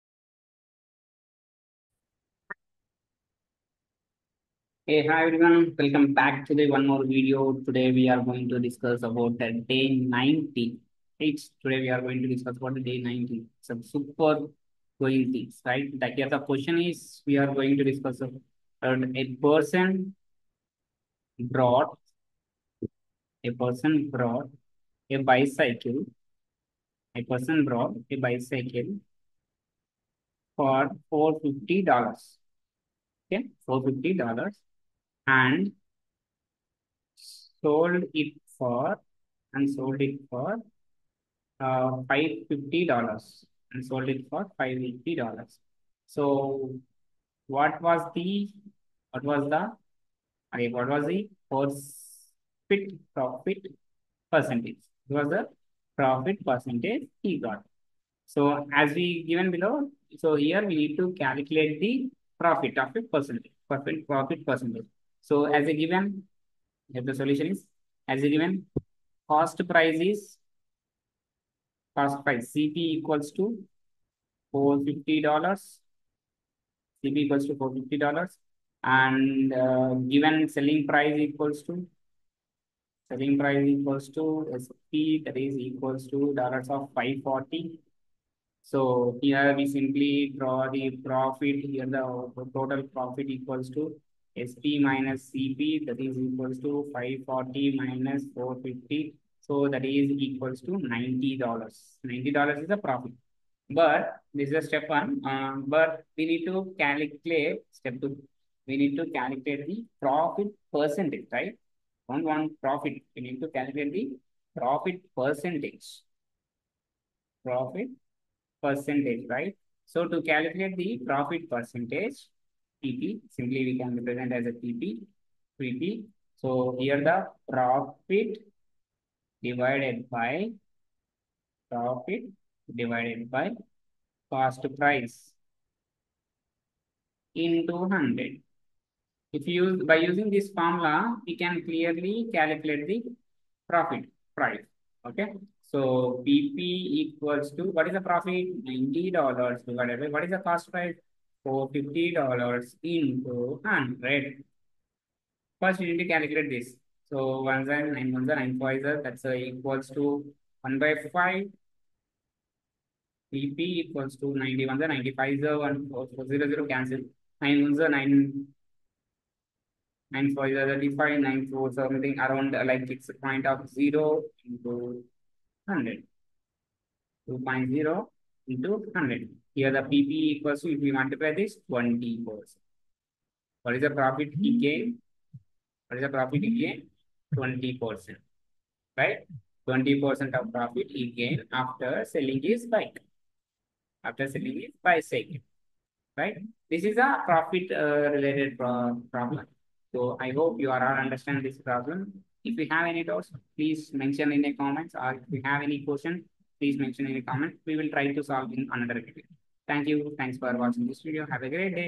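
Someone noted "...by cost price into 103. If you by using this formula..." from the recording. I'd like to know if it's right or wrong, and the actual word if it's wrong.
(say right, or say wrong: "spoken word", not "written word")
wrong: "100", not "103".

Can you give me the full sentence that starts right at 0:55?
It was the profit percentage he got.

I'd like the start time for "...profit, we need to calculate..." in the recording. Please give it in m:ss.
1:52.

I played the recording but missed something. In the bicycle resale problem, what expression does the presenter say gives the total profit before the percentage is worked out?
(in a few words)
SP minus CP.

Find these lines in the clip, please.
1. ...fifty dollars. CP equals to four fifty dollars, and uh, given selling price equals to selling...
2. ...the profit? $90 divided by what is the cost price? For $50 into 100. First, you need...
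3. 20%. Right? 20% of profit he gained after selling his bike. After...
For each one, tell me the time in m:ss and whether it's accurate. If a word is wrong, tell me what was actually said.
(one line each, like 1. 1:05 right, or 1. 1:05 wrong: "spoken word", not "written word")
1. 1:14 right
2. 2:27 right
3. 3:07 right.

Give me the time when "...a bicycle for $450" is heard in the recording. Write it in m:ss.
0:28.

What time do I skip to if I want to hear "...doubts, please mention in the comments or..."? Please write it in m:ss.
3:23.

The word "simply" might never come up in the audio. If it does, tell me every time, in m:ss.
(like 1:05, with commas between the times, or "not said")
1:29, 2:03.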